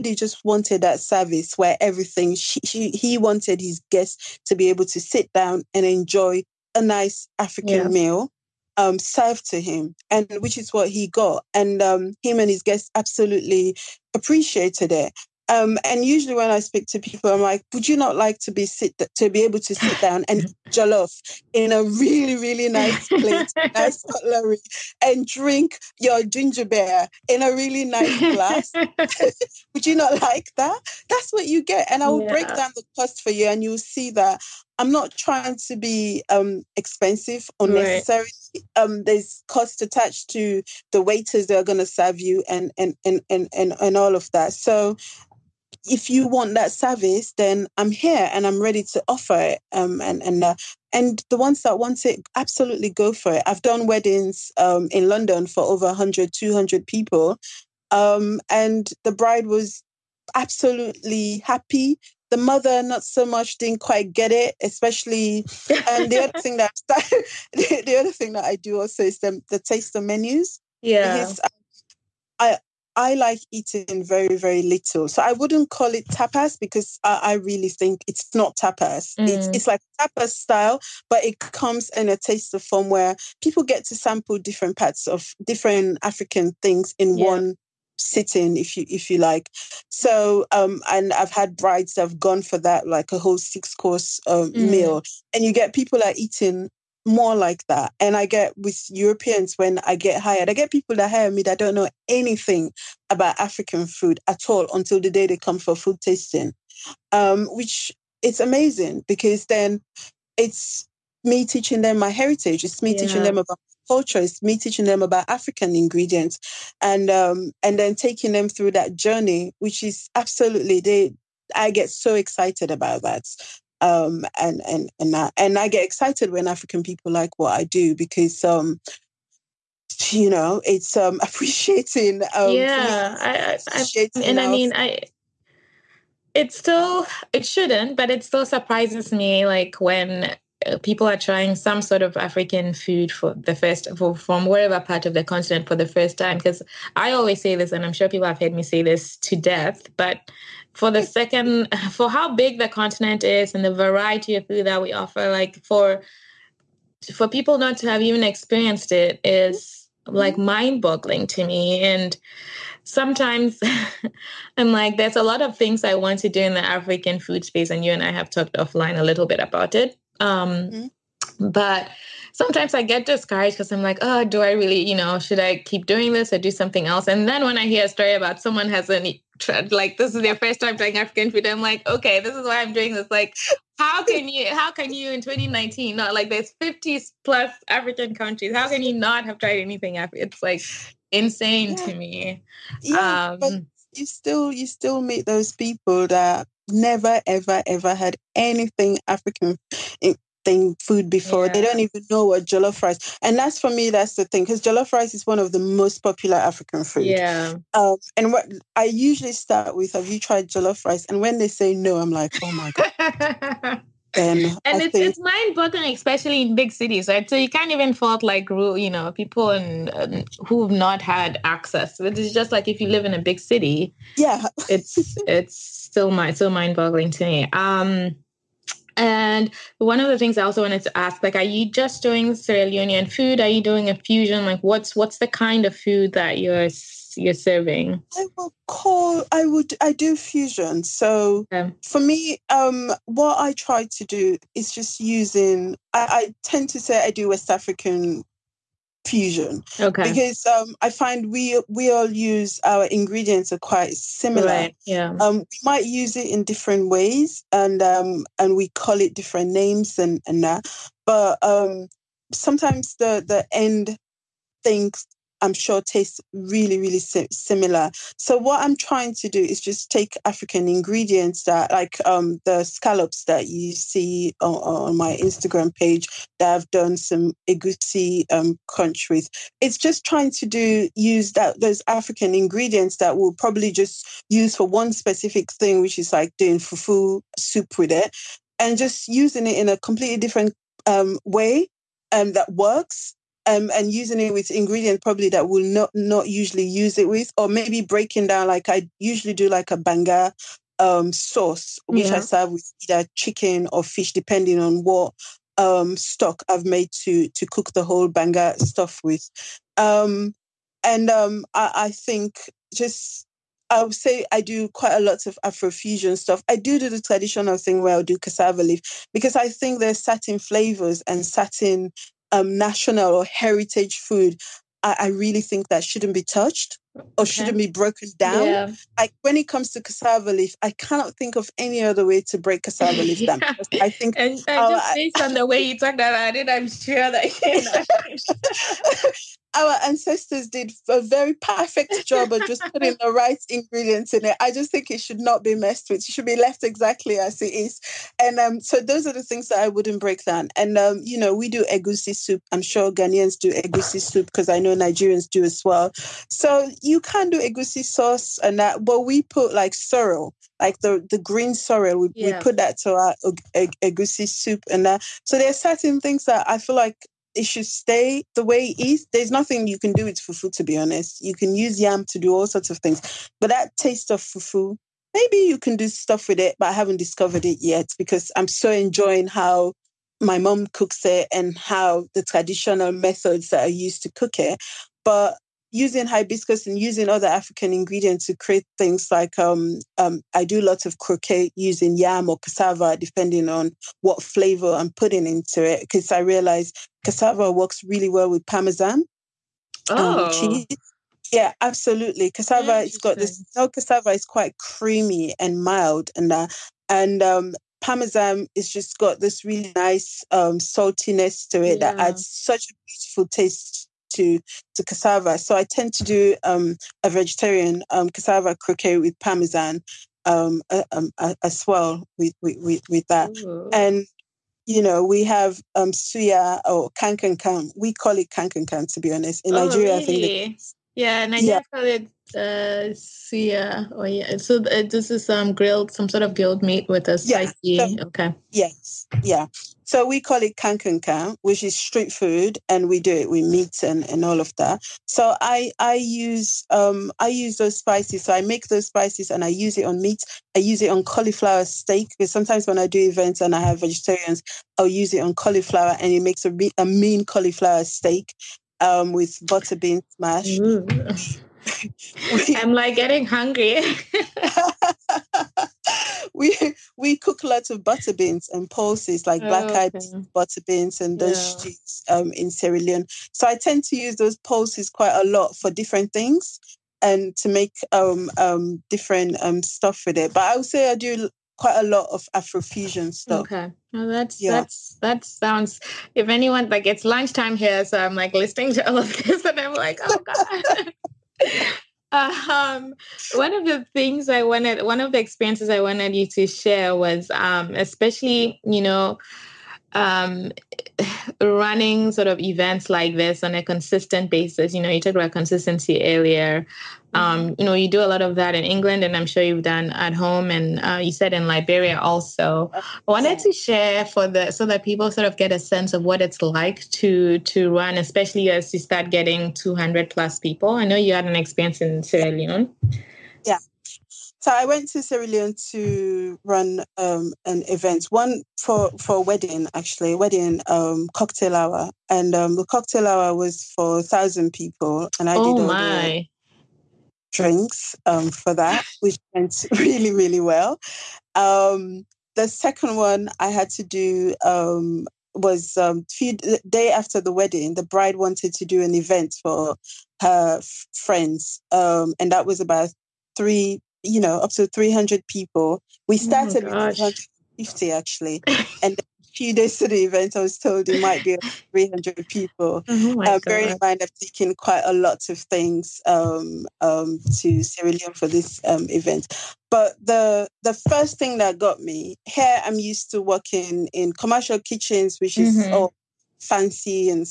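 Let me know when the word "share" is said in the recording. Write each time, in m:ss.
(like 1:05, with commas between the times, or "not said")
8:16, 8:33.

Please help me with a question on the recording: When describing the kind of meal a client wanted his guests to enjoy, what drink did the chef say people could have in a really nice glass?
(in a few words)
Ginger beer.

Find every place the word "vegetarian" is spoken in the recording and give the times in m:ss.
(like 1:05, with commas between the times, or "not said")
6:57, 7:33.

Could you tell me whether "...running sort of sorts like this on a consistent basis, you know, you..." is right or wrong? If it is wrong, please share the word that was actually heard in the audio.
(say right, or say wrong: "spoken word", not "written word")
wrong: "events", not "sorts".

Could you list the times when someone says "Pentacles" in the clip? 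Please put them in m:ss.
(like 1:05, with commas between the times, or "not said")
not said.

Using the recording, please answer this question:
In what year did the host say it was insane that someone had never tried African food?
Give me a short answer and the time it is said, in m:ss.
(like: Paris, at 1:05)
2019, at 3:05.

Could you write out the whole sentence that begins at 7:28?
So I make those spices and I use it on meat.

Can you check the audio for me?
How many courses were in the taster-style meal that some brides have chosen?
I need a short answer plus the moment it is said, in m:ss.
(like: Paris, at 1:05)
Six, at 1:33.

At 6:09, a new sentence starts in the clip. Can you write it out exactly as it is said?
There's nothing you can do with fufu, to be honest.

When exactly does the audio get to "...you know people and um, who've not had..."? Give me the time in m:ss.
3:38.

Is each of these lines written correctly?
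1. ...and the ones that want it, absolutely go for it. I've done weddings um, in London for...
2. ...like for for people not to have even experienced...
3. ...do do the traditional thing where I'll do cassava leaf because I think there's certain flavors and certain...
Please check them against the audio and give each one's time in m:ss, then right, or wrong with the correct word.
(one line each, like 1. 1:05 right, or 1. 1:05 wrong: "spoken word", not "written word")
1. 0:50 right
2. 2:35 right
3. 5:16 right.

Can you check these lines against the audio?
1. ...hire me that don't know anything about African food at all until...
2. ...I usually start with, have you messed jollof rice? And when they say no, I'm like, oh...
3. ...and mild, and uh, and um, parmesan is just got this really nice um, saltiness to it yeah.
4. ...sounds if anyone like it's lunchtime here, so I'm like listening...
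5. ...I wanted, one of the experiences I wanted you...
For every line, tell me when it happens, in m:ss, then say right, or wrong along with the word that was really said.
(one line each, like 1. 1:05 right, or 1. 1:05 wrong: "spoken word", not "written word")
1. 1:41 right
2. 3:28 wrong: "tried", not "messed"
3. 6:45 right
4. 8:05 right
5. 8:14 right.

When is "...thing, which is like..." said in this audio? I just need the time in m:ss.
4:45.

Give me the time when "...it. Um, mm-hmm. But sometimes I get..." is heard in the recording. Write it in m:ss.
2:49.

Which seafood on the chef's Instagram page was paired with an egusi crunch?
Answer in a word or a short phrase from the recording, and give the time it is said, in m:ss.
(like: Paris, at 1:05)
Scallops, at 4:32.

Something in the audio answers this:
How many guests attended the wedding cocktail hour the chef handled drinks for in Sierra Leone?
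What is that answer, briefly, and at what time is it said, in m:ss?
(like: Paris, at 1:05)
1,000, at 8:53.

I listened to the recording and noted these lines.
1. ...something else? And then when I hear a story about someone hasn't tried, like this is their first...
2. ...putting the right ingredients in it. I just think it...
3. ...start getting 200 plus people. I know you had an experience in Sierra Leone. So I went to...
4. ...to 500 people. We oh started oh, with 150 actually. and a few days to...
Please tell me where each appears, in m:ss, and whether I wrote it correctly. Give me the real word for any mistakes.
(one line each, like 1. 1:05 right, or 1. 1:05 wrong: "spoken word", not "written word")
1. 2:56 right
2. 5:42 right
3. 8:38 right
4. 9:14 wrong: "300", not "500".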